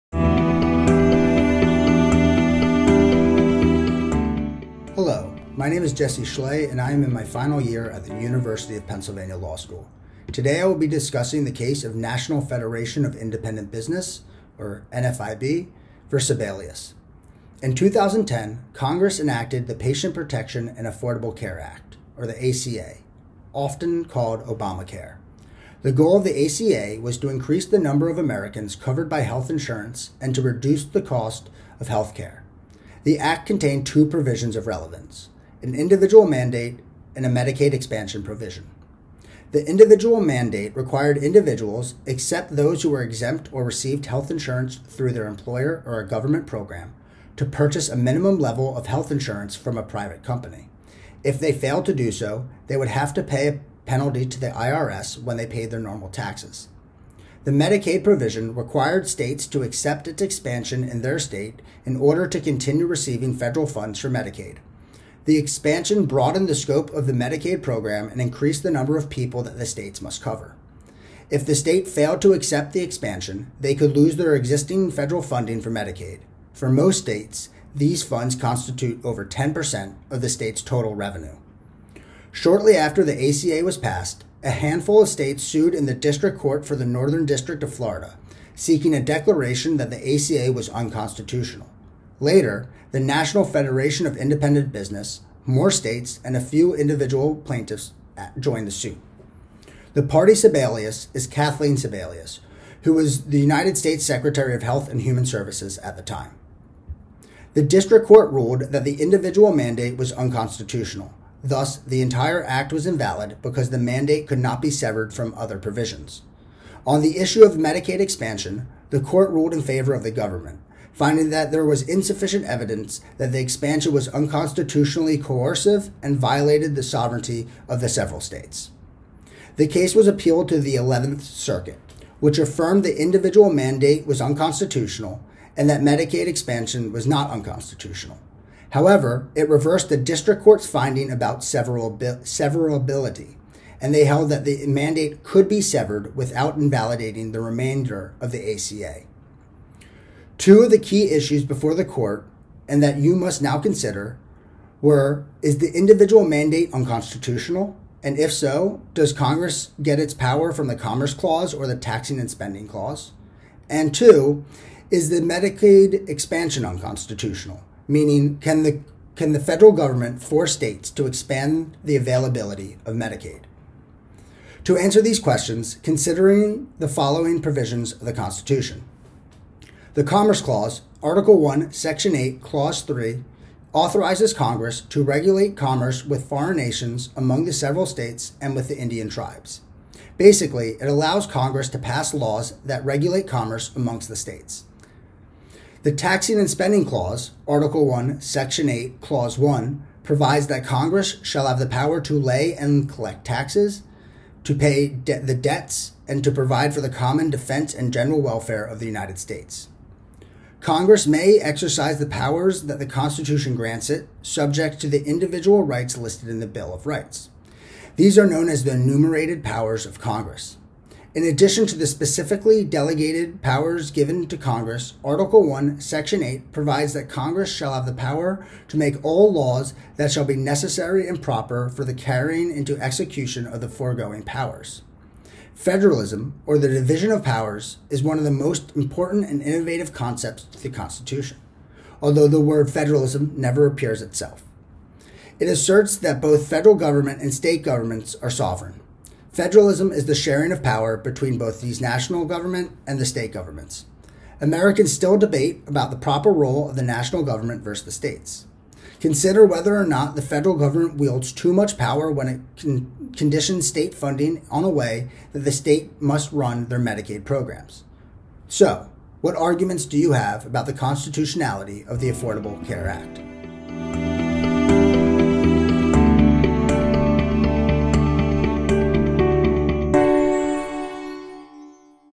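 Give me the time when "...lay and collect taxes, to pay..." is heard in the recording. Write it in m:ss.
3:22.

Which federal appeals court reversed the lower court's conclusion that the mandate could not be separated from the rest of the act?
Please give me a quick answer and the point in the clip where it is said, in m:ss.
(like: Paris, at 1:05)
11th Circuit, at 2:10.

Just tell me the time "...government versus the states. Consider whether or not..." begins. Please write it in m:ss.
4:17.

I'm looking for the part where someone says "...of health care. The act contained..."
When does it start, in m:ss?
0:31.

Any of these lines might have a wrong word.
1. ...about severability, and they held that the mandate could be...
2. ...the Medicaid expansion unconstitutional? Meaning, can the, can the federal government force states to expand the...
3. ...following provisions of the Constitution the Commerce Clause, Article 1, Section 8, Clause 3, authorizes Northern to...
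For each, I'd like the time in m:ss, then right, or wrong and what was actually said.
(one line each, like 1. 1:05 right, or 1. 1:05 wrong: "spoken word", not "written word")
1. 2:21 right
2. 2:45 right
3. 2:56 wrong: "Congress", not "Northern".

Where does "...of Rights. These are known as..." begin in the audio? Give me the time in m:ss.
3:36.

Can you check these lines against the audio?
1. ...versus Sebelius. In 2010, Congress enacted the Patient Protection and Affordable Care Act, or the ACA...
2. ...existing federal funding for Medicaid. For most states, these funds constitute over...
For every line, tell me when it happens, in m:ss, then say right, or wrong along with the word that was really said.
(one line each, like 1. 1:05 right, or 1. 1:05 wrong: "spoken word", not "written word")
1. 0:16 right
2. 1:14 right.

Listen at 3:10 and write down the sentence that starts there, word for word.
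Basically, it allows Congress to pass laws that regulate commerce amongst the states.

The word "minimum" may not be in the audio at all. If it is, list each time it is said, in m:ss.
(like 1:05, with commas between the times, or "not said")
0:47.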